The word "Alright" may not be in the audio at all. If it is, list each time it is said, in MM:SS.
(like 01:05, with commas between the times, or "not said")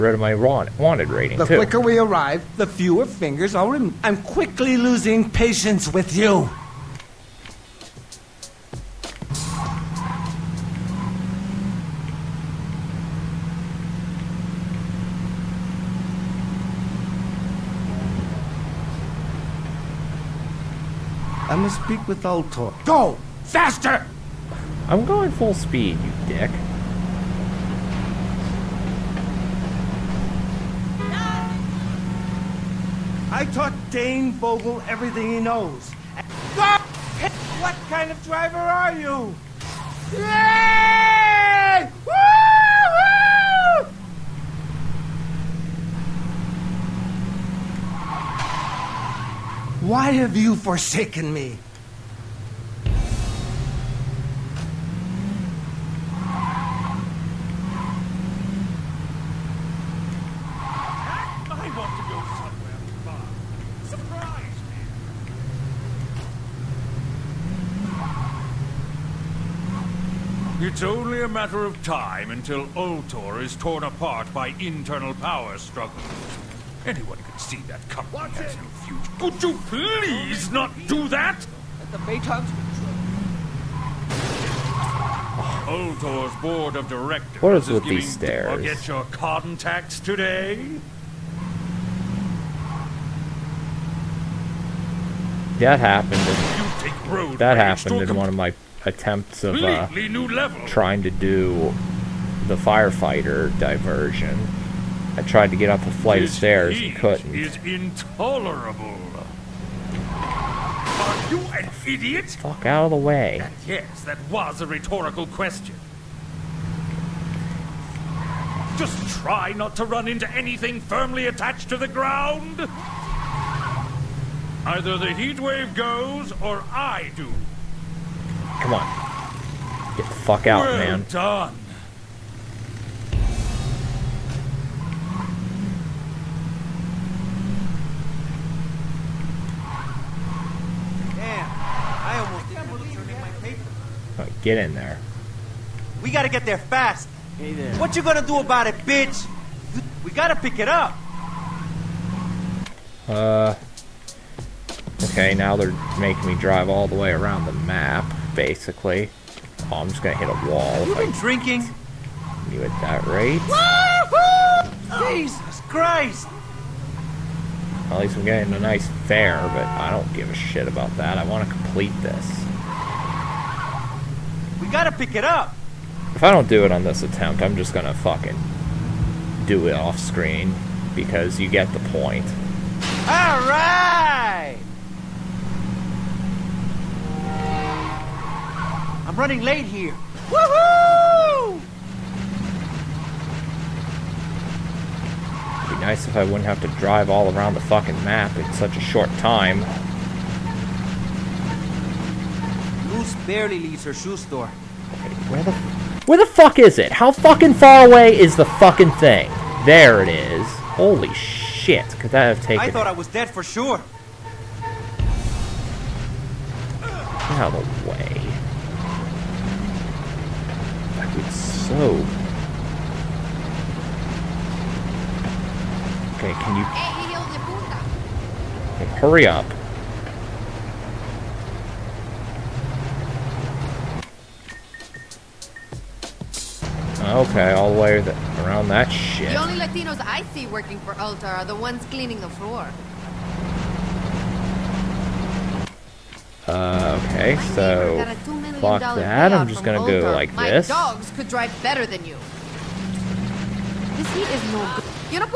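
03:03.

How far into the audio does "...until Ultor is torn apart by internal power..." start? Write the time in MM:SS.
01:12.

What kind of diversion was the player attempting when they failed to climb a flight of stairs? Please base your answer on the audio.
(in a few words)
firefighter diversion.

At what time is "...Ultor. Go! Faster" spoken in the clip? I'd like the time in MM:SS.
00:22.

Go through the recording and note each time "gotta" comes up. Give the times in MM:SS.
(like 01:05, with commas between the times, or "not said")
02:26, 02:30, 02:54.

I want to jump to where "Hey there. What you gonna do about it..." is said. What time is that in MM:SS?
02:27.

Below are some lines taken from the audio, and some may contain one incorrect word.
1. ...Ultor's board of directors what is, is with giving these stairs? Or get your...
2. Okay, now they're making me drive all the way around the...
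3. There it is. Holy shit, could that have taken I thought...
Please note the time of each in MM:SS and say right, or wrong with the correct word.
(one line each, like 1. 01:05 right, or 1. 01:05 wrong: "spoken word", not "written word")
1. 01:25 right
2. 02:35 right
3. 03:29 right.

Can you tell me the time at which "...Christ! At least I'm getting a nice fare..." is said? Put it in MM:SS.
02:45.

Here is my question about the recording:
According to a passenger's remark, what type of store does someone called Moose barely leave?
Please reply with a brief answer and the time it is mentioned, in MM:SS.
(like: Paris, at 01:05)
shoe store, at 03:23.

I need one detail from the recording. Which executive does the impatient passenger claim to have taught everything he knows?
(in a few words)
Dane Vogel.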